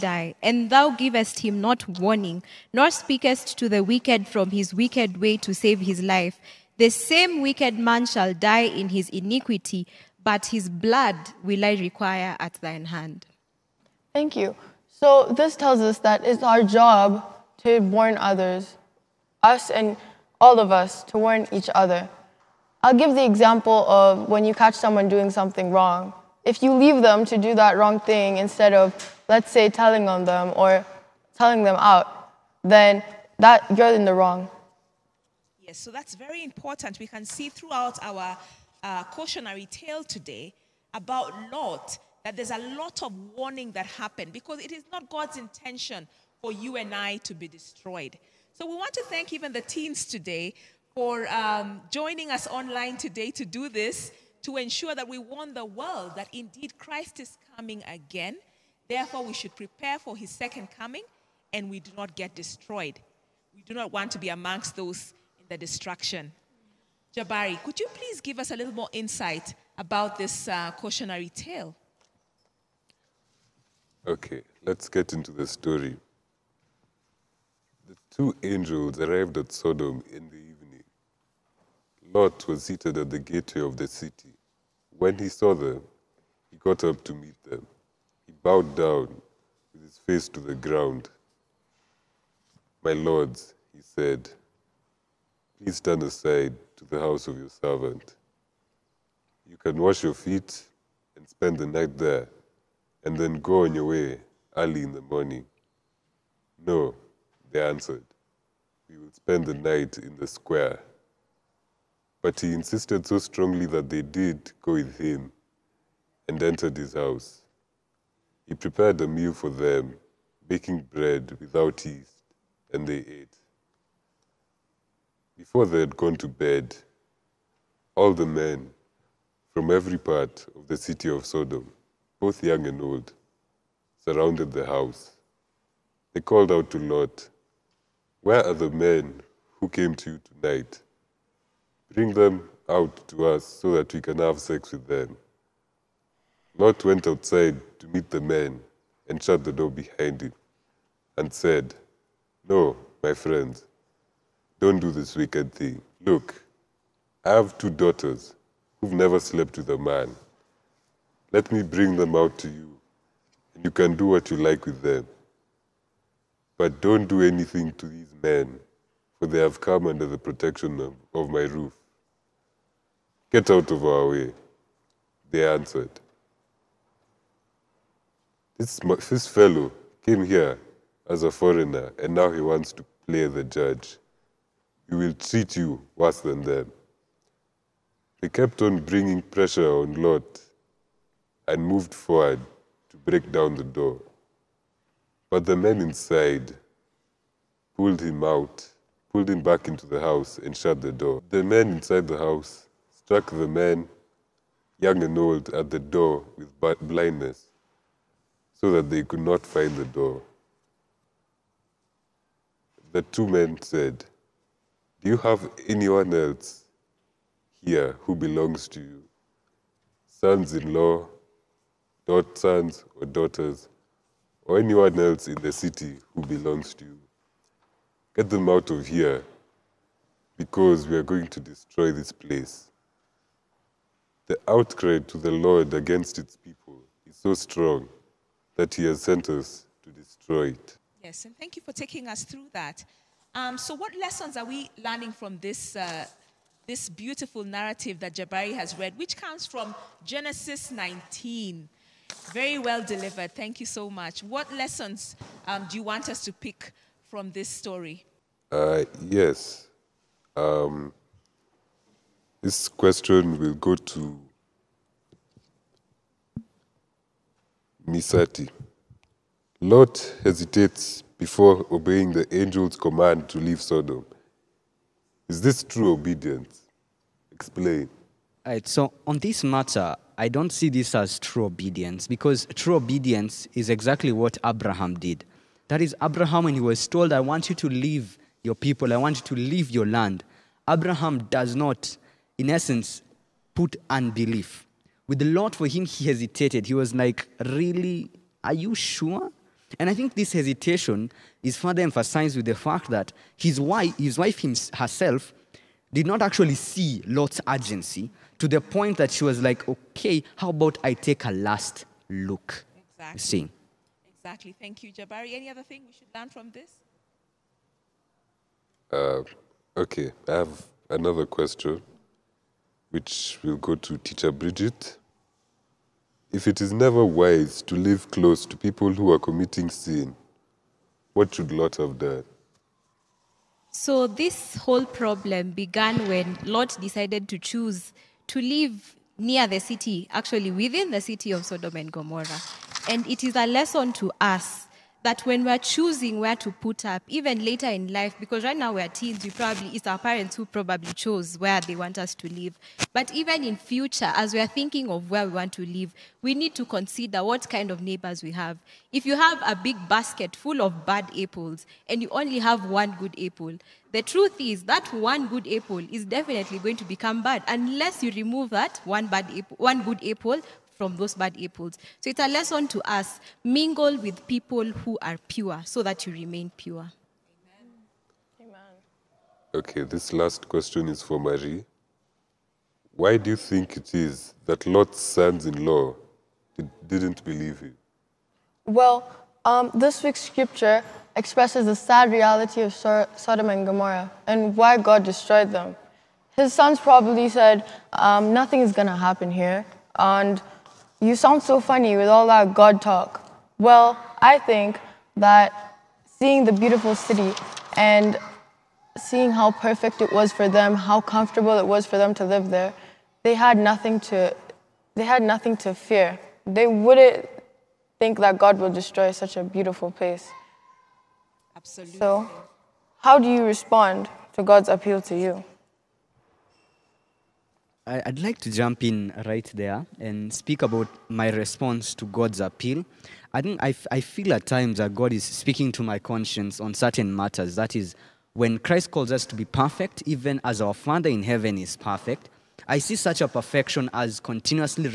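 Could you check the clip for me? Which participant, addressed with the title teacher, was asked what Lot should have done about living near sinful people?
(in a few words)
Bridget.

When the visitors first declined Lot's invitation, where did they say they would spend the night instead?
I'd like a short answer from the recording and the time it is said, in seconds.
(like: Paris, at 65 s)
In the square, at 110 s.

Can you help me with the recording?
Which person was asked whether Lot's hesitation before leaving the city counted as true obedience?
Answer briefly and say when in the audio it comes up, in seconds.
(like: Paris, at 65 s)
Misati, at 267 s.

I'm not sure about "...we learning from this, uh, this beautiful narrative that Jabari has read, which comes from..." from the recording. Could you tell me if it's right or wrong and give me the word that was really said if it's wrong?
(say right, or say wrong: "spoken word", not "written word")
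right.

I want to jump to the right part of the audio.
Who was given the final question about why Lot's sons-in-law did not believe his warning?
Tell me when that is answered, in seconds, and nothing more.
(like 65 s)
381 s.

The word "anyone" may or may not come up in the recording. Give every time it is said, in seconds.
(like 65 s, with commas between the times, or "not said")
215 s, 224 s.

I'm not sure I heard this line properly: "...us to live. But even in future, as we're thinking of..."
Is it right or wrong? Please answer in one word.
right.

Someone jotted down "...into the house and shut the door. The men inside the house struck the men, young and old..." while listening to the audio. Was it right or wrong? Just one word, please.
right.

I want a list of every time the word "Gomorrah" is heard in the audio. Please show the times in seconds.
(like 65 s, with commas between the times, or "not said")
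341 s, 393 s.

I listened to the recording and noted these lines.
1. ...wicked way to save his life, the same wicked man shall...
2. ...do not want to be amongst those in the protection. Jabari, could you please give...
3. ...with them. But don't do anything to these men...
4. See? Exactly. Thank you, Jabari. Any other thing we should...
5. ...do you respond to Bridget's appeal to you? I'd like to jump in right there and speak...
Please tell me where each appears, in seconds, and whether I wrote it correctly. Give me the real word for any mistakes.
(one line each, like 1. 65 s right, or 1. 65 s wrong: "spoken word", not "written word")
1. 4 s right
2. 63 s wrong: "destruction", not "protection"
3. 164 s right
4. 313 s right
5. 423 s wrong: "God", not "Bridget".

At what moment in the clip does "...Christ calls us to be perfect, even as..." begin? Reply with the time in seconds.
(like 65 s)
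438 s.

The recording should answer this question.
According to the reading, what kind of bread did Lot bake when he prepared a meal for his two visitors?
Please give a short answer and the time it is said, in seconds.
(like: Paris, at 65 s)
Bread without yeast, at 120 s.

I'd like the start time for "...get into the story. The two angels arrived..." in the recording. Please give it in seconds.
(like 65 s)
74 s.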